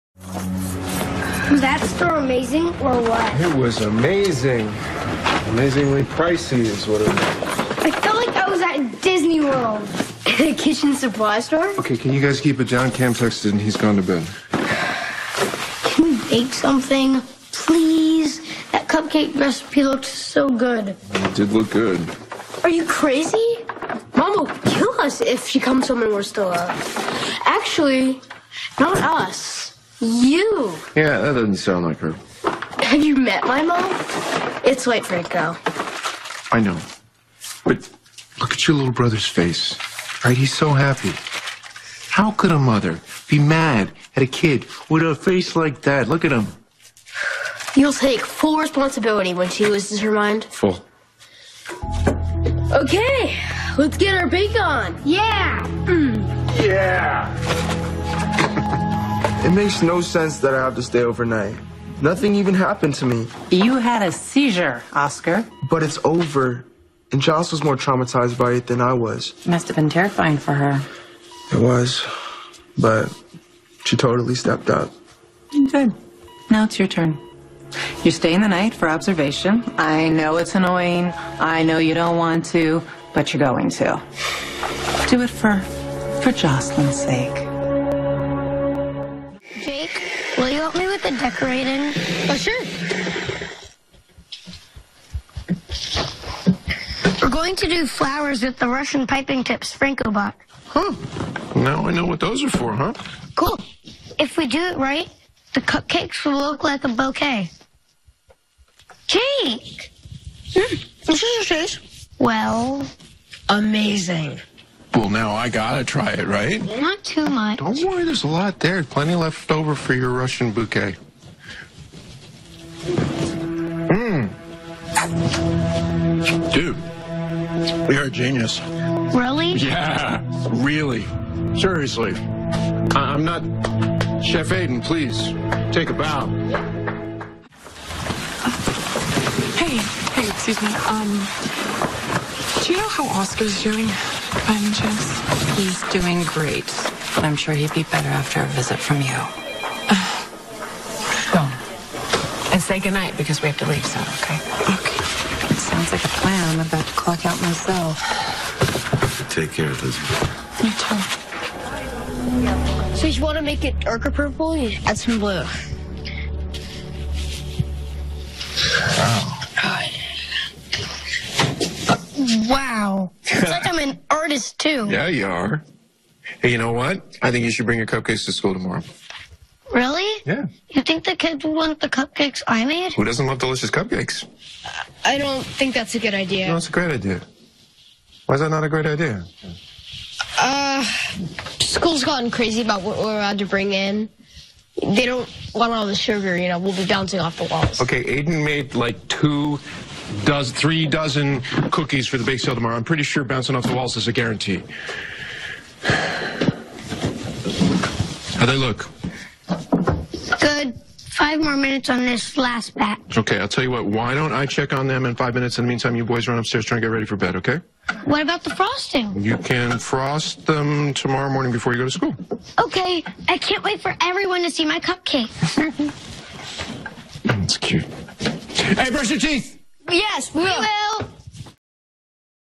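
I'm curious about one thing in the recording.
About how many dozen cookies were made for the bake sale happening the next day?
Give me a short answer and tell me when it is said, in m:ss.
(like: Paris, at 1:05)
3 dozen, at 3:20.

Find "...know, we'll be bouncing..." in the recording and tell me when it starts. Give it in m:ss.
3:16.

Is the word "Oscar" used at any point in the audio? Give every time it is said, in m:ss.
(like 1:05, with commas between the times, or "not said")
1:04, 2:23.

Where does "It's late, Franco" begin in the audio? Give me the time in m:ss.
0:34.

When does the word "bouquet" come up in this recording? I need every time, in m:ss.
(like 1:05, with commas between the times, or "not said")
1:46, 2:00.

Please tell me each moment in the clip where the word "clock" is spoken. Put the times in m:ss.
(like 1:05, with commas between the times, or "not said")
2:36.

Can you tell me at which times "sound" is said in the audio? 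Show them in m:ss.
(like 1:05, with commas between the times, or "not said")
0:31, 2:35.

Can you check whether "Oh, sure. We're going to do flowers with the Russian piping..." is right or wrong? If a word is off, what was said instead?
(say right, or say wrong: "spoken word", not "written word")
right.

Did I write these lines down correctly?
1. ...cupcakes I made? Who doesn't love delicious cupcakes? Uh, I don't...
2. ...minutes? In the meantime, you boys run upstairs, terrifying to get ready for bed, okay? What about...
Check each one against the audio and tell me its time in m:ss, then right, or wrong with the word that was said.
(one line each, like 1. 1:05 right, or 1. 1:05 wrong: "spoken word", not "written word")
1. 3:01 right
2. 3:35 wrong: "trying", not "terrifying".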